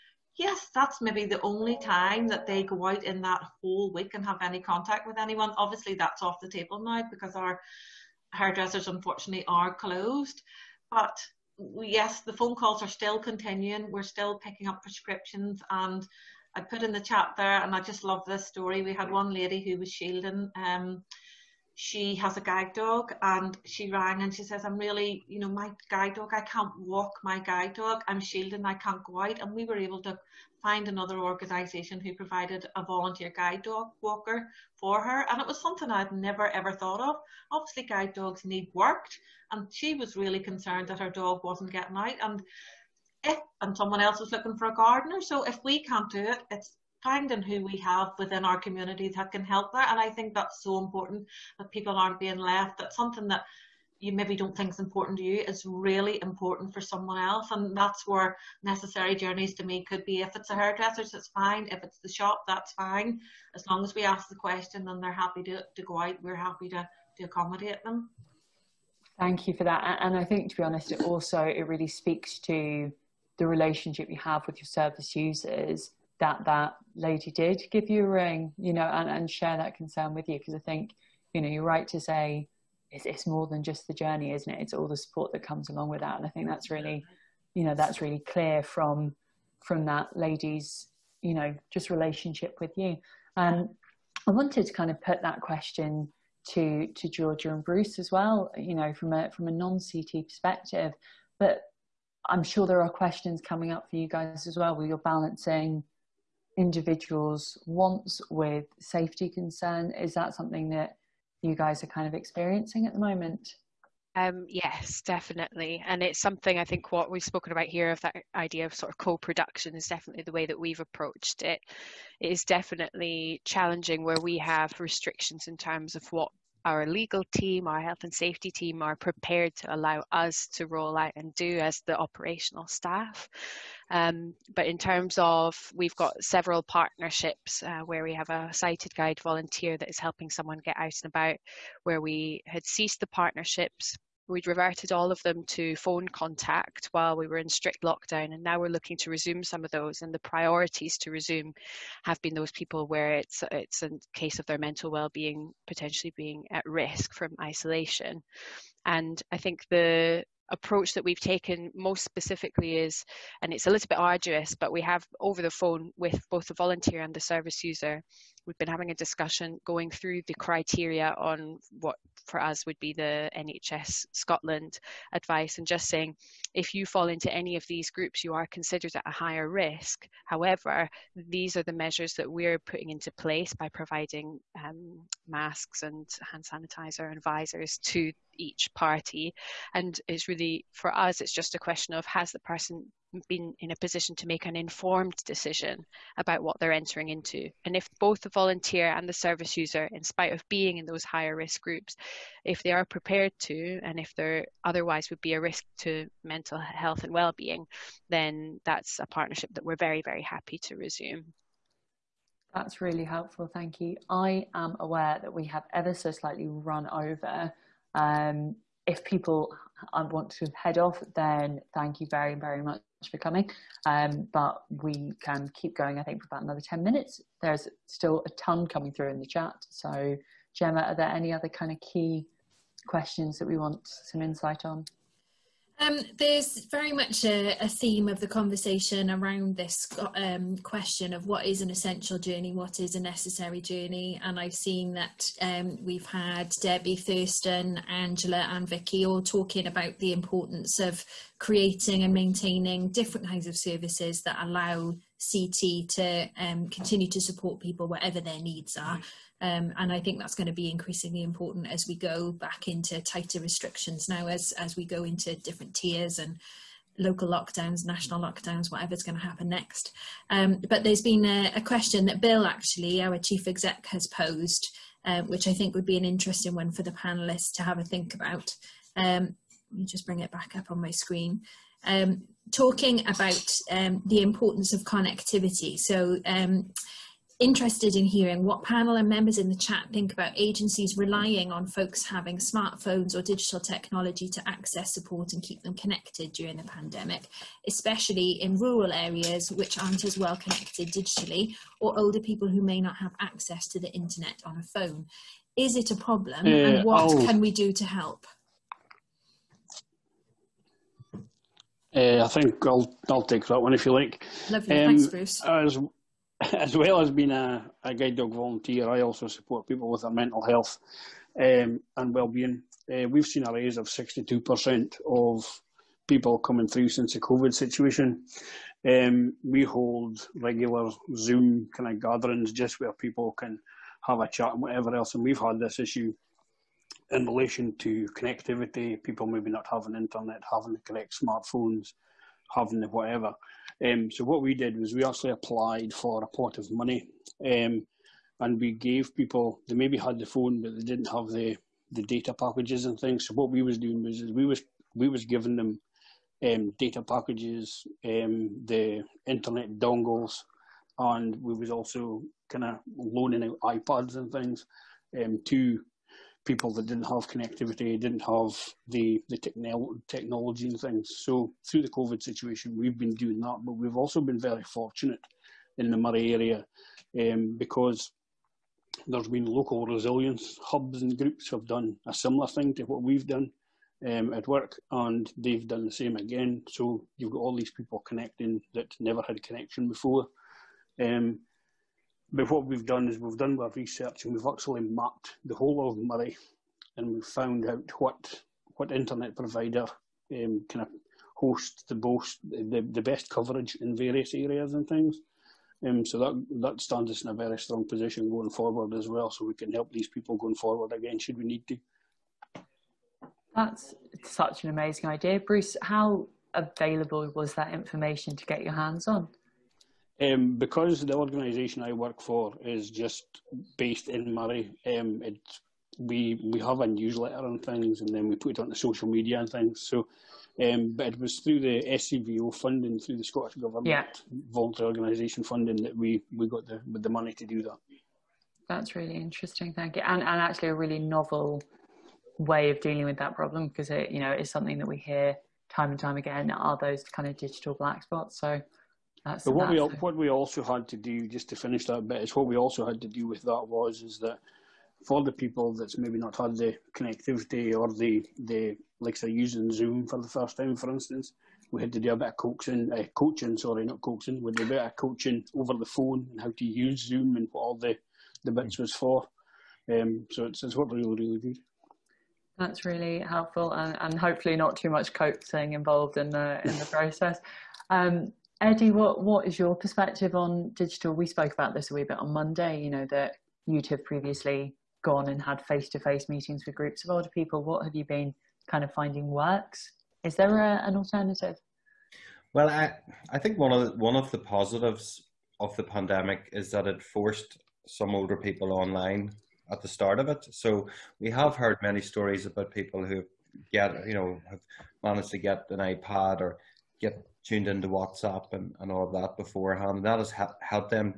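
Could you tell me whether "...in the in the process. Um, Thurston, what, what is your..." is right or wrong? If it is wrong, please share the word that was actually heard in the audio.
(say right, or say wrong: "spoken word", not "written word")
wrong: "Eddie", not "Thurston".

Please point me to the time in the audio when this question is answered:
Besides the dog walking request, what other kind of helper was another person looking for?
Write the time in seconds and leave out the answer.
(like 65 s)
44 s.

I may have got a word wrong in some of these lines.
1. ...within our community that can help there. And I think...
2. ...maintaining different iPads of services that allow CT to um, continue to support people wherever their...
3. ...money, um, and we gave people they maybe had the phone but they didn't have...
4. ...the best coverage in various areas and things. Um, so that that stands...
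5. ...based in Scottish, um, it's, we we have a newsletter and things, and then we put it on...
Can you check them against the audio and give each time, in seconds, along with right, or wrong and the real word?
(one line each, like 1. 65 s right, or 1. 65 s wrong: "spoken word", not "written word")
1. 48 s right
2. 252 s wrong: "kinds", not "iPads"
3. 346 s right
4. 402 s right
5. 423 s wrong: "Moray", not "Scottish".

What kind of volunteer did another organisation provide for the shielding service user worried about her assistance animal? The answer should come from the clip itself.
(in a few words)
guide dog walker.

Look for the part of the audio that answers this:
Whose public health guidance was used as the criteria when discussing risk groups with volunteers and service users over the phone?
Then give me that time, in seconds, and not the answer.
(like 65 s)
173 s.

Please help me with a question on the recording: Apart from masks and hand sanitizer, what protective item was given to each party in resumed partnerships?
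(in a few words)
visors.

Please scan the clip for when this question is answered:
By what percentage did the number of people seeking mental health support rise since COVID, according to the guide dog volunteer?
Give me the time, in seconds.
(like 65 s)
323 s.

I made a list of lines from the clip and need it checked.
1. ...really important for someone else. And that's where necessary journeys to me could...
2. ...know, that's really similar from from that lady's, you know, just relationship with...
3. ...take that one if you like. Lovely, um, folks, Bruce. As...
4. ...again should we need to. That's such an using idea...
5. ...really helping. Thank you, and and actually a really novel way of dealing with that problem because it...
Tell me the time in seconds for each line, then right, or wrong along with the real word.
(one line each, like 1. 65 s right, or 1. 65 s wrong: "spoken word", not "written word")
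1. 55 s right
2. 87 s wrong: "clear", not "similar"
3. 313 s wrong: "thanks", not "folks"
4. 410 s wrong: "amazing", not "using"
5. 438 s wrong: "interesting", not "helping".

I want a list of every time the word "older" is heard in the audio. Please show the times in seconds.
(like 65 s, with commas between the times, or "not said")
301 s, 487 s, 498 s.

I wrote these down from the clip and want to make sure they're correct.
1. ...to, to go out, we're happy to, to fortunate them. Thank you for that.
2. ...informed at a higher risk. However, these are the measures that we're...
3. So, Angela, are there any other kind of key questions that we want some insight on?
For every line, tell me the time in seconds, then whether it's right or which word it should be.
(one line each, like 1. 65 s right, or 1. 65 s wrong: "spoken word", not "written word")
1. 65 s wrong: "accommodate", not "fortunate"
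2. 178 s wrong: "considered", not "informed"
3. 229 s wrong: "Gemma", not "Angela".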